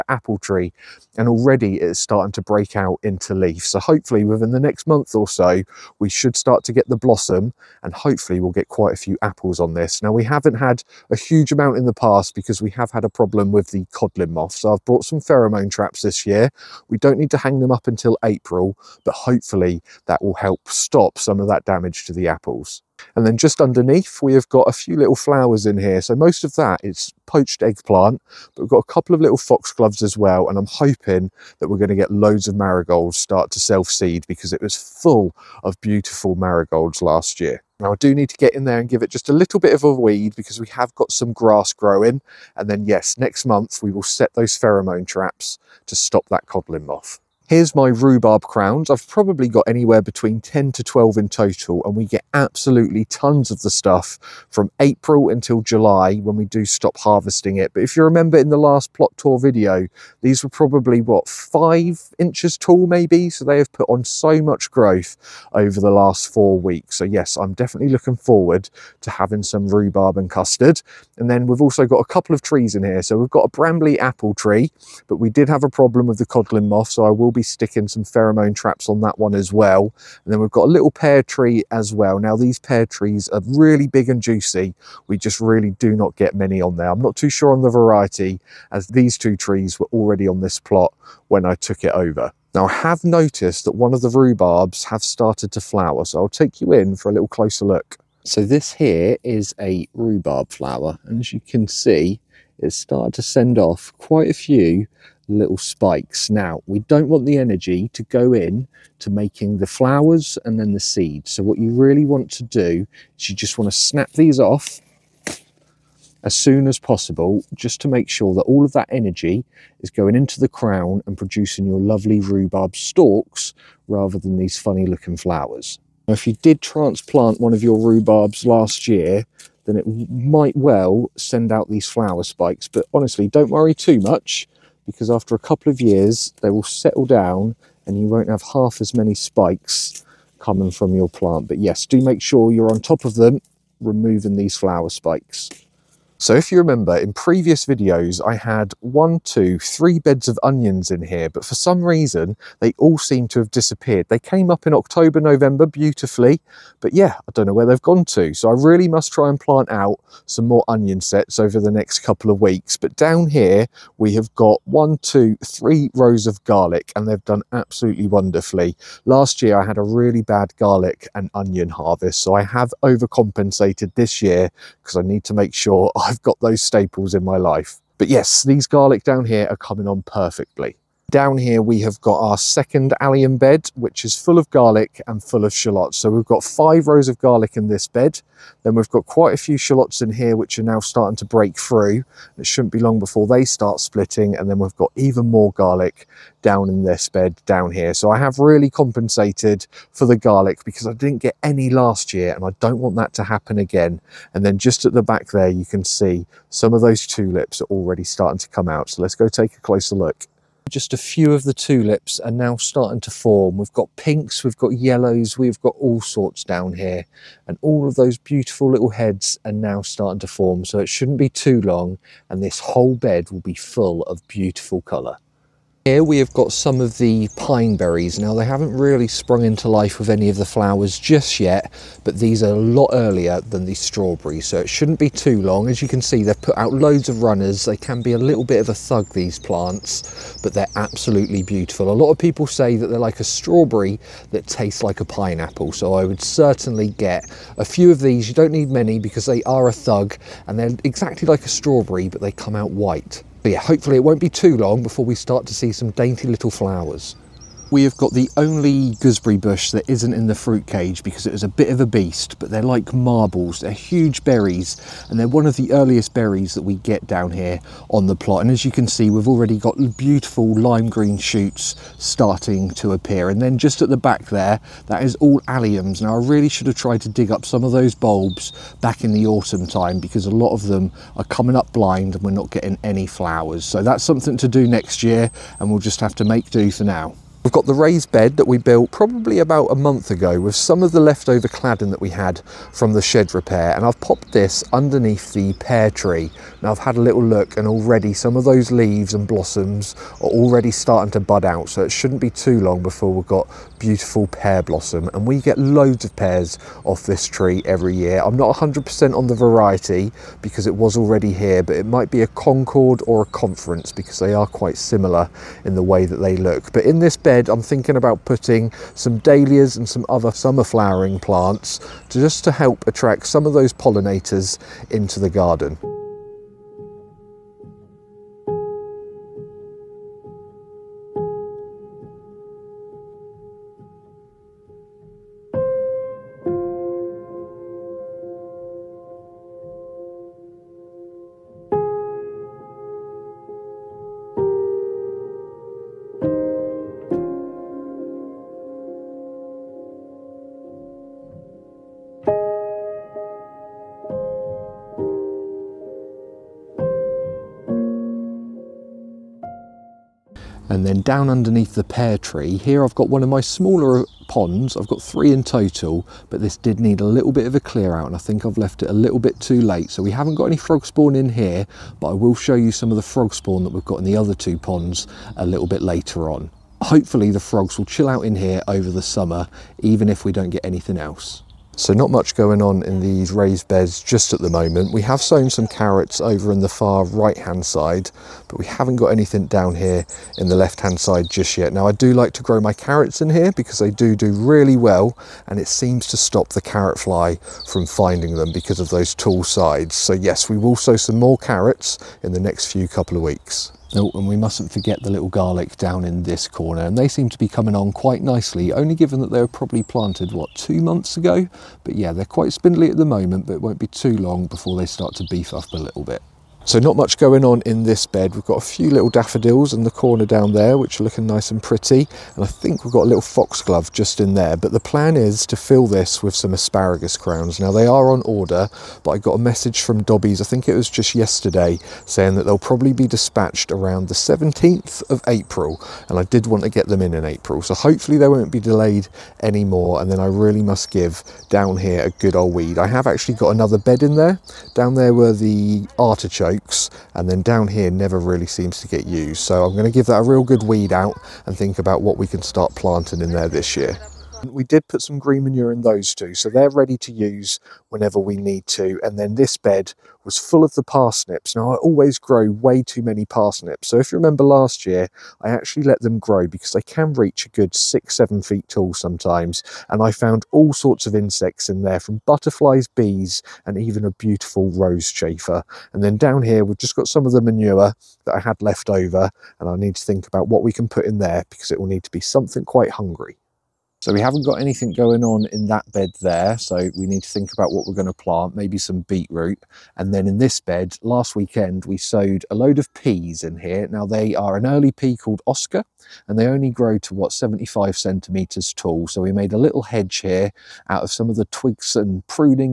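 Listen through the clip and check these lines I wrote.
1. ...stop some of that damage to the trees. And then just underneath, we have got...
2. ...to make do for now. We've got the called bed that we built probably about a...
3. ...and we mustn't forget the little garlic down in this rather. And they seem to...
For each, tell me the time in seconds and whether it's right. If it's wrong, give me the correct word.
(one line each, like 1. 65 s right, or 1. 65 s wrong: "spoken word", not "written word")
1. 20 s wrong: "apples", not "trees"
2. 286 s wrong: "raised", not "called"
3. 404 s wrong: "corner", not "rather".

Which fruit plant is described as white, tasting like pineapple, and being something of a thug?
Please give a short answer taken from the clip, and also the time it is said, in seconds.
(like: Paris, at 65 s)
pine berries, at 227 s.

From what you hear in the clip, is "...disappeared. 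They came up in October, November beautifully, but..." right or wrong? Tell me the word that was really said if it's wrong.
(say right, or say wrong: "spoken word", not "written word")
right.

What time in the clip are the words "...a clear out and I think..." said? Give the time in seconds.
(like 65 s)
367 s.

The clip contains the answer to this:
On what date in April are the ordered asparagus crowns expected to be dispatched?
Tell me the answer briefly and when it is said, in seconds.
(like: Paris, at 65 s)
17th of April, at 434 s.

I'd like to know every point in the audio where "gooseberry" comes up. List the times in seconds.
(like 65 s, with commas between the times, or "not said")
258 s.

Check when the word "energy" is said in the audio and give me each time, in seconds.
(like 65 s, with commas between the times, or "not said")
107 s, 118 s.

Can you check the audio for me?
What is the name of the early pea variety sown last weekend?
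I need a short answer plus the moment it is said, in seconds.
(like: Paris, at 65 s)
Oscar, at 495 s.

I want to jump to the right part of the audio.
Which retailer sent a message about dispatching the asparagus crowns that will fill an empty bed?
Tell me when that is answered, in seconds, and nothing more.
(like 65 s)
430 s.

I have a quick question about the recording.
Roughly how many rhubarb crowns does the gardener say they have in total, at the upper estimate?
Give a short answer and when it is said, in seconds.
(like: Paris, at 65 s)
12, at 50 s.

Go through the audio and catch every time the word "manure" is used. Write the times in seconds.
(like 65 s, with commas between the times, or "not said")
455 s, 477 s.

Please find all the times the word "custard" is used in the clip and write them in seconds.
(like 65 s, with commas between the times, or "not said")
70 s.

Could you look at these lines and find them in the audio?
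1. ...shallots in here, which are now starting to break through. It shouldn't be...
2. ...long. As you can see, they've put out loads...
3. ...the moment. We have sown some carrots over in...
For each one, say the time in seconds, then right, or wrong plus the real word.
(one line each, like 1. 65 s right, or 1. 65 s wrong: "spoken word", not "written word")
1. 189 s right
2. 235 s right
3. 384 s right.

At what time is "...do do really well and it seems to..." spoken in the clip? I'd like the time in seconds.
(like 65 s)
393 s.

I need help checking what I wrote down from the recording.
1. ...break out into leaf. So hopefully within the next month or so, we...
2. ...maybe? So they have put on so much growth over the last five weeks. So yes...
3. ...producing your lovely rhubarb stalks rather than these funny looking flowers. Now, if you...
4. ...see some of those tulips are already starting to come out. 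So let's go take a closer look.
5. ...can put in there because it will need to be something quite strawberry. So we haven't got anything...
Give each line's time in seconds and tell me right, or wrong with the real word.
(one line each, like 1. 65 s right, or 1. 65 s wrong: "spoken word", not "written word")
1. 2 s right
2. 62 s wrong: "four", not "five"
3. 121 s right
4. 205 s right
5. 480 s wrong: "hungry", not "strawberry".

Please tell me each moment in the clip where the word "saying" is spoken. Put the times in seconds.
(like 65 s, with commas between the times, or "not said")
432 s.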